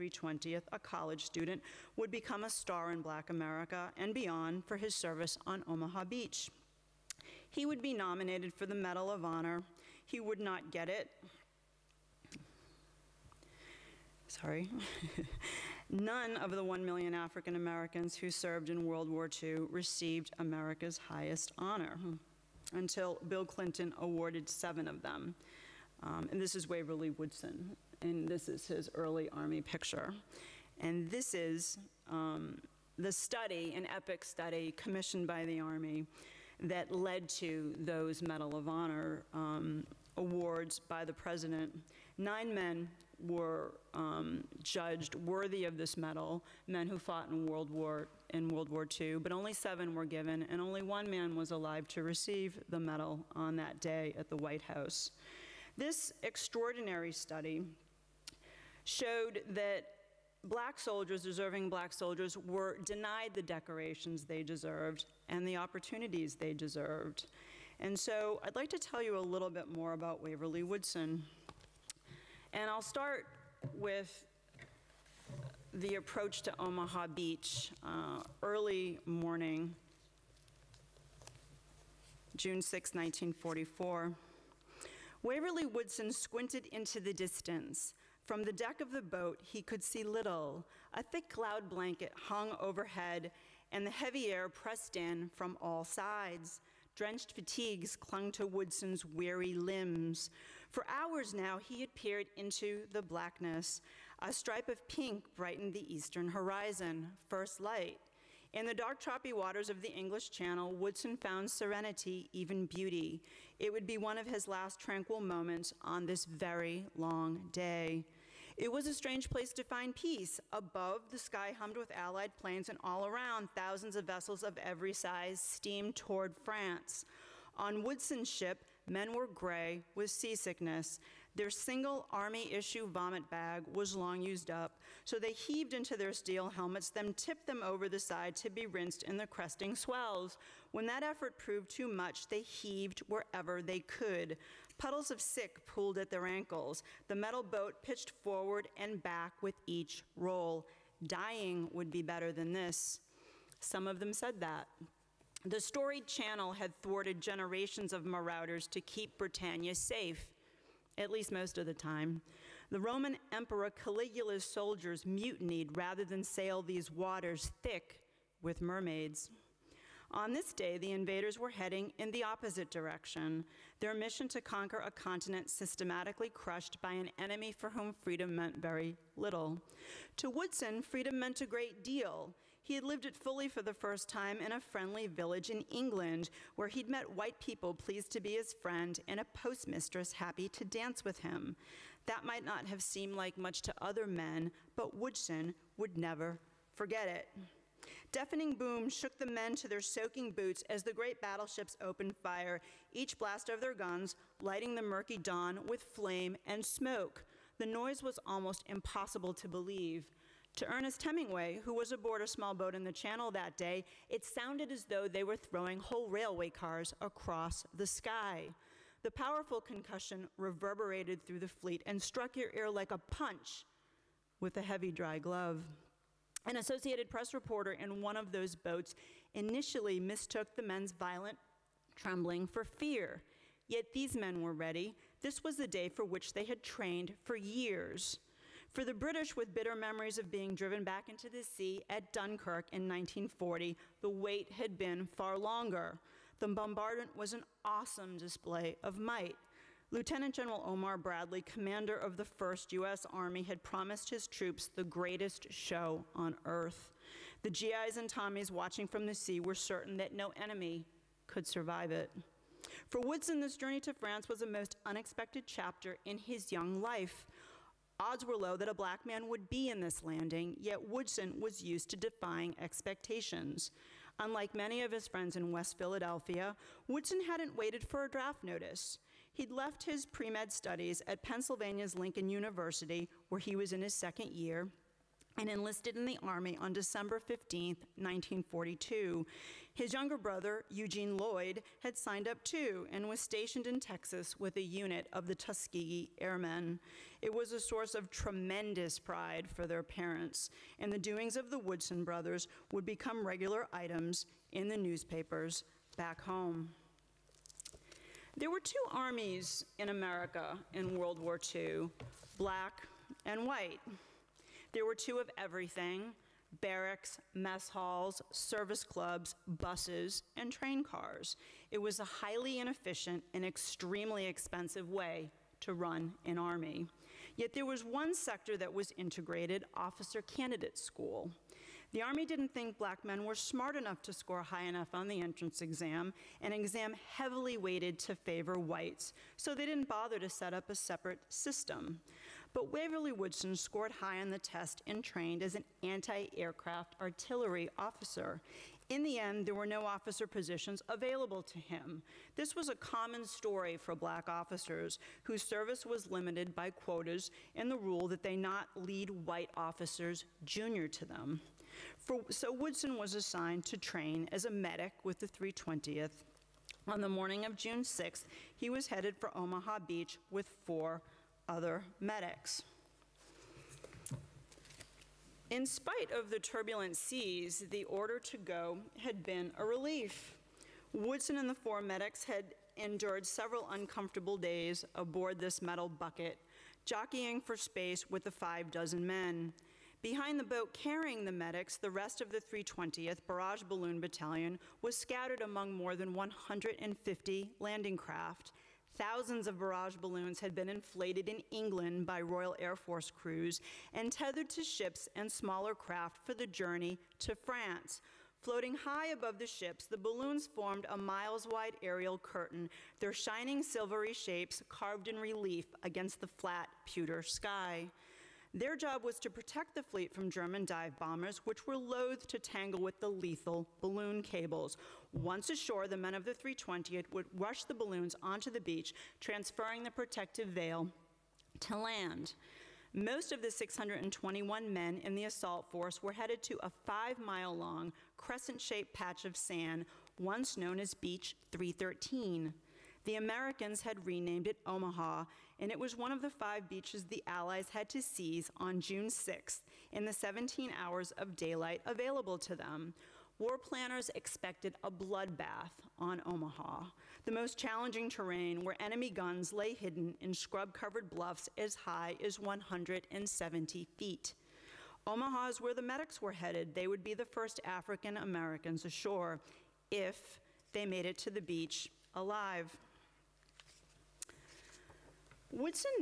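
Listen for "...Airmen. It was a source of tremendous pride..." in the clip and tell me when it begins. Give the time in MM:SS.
04:56.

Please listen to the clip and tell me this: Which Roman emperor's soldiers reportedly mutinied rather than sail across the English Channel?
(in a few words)
Caligula.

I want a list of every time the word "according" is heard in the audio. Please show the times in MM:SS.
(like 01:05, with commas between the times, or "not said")
not said.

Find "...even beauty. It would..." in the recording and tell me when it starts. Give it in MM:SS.
01:52.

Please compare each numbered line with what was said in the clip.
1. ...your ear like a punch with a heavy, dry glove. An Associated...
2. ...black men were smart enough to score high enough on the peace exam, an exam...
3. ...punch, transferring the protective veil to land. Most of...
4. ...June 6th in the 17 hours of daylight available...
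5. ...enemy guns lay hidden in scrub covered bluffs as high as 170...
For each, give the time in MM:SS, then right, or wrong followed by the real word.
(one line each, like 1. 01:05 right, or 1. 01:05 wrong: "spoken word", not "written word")
1. 03:42 right
2. 05:32 wrong: "entrance", not "peace"
3. 07:08 wrong: "beach", not "punch"
4. 07:28 right
5. 07:38 right.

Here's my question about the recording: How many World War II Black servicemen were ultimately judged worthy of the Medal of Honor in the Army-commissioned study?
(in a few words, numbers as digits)
9.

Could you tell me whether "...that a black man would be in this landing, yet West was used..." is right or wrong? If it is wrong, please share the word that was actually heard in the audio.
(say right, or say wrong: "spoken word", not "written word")
wrong: "Woodson", not "West".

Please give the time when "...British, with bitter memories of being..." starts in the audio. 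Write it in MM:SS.
03:58.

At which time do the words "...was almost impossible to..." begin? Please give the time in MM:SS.
03:28.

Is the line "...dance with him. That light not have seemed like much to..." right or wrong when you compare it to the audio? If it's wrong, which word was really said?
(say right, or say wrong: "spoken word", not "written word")
wrong: "might", not "light".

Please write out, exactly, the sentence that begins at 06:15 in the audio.
In spite of the turbulent seas, the order to go had been a relief.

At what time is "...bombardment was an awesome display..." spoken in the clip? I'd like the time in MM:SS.
04:06.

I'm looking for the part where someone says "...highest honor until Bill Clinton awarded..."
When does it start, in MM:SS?
00:20.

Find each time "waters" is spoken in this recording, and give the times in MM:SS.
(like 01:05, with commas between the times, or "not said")
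01:49, 02:46.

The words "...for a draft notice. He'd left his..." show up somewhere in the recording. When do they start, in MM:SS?
04:37.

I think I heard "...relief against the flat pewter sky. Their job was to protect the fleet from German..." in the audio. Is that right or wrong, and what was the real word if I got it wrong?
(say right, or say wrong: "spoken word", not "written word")
right.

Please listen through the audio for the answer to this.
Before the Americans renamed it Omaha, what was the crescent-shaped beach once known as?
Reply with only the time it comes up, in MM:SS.
07:20.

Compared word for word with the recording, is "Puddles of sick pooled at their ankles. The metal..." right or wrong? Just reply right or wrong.
right.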